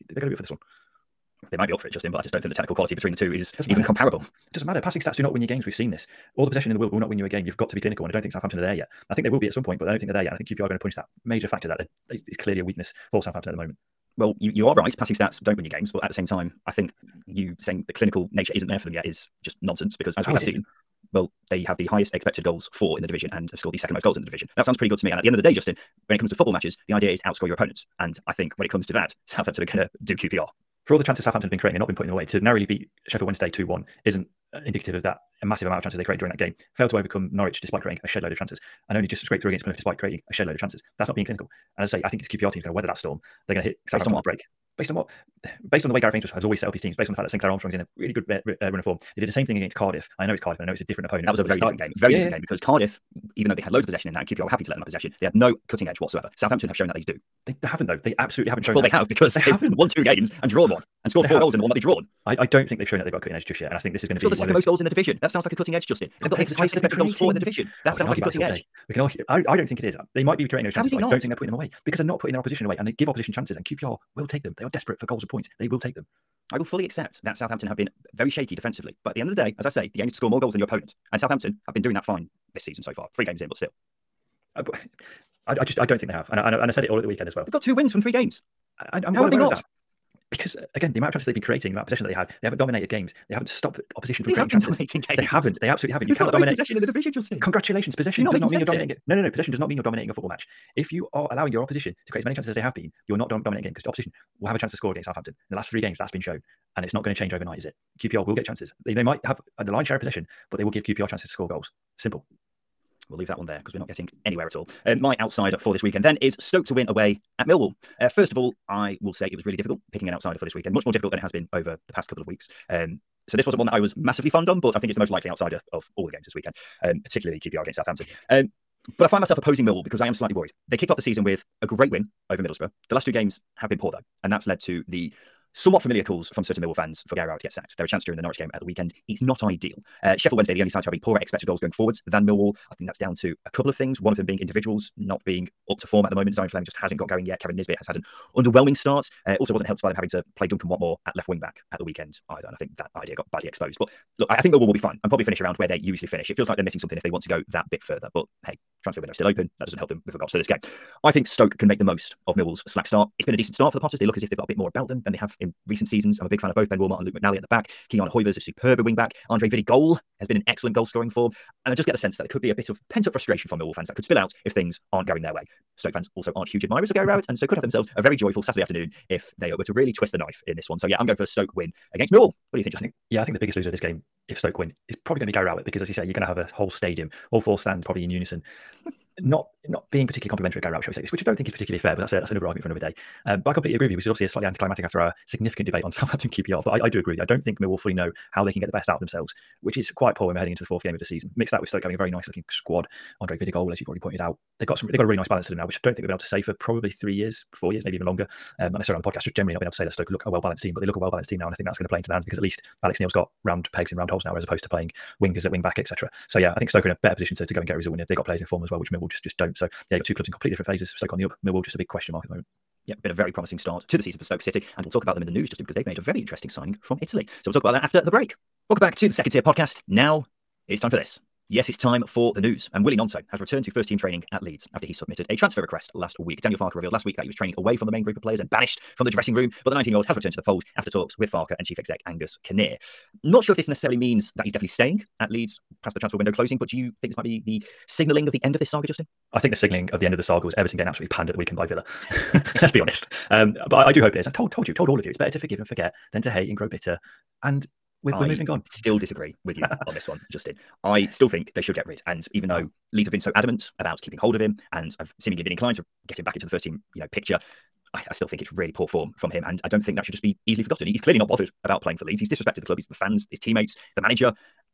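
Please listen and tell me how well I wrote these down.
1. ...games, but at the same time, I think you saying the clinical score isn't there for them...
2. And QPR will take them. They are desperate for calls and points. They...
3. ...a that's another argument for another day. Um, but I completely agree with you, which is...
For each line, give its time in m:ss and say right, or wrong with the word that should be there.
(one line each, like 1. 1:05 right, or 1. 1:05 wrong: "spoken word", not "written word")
1. 0:15 wrong: "nature", not "score"
2. 1:13 wrong: "goals", not "calls"
3. 3:12 right.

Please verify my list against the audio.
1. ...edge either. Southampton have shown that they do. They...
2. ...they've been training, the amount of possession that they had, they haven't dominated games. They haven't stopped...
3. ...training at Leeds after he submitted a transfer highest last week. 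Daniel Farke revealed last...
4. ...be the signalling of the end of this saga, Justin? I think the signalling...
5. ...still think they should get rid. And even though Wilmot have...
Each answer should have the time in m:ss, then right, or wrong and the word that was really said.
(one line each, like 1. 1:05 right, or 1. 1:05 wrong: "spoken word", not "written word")
1. 0:55 wrong: "whatsoever", not "either"
2. 1:31 wrong: "creating", not "training"
3. 3:53 wrong: "request", not "highest"
4. 4:07 right
5. 4:21 wrong: "Leeds", not "Wilmot".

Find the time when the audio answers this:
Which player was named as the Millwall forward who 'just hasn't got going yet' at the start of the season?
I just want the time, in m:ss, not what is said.
2:26.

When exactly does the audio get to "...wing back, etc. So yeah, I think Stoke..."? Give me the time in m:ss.
3:35.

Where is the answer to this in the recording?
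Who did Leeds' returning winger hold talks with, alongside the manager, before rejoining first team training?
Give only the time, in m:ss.
4:02.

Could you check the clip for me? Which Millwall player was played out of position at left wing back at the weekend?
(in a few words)
Duncan Watmore.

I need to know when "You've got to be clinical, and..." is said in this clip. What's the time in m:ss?
0:07.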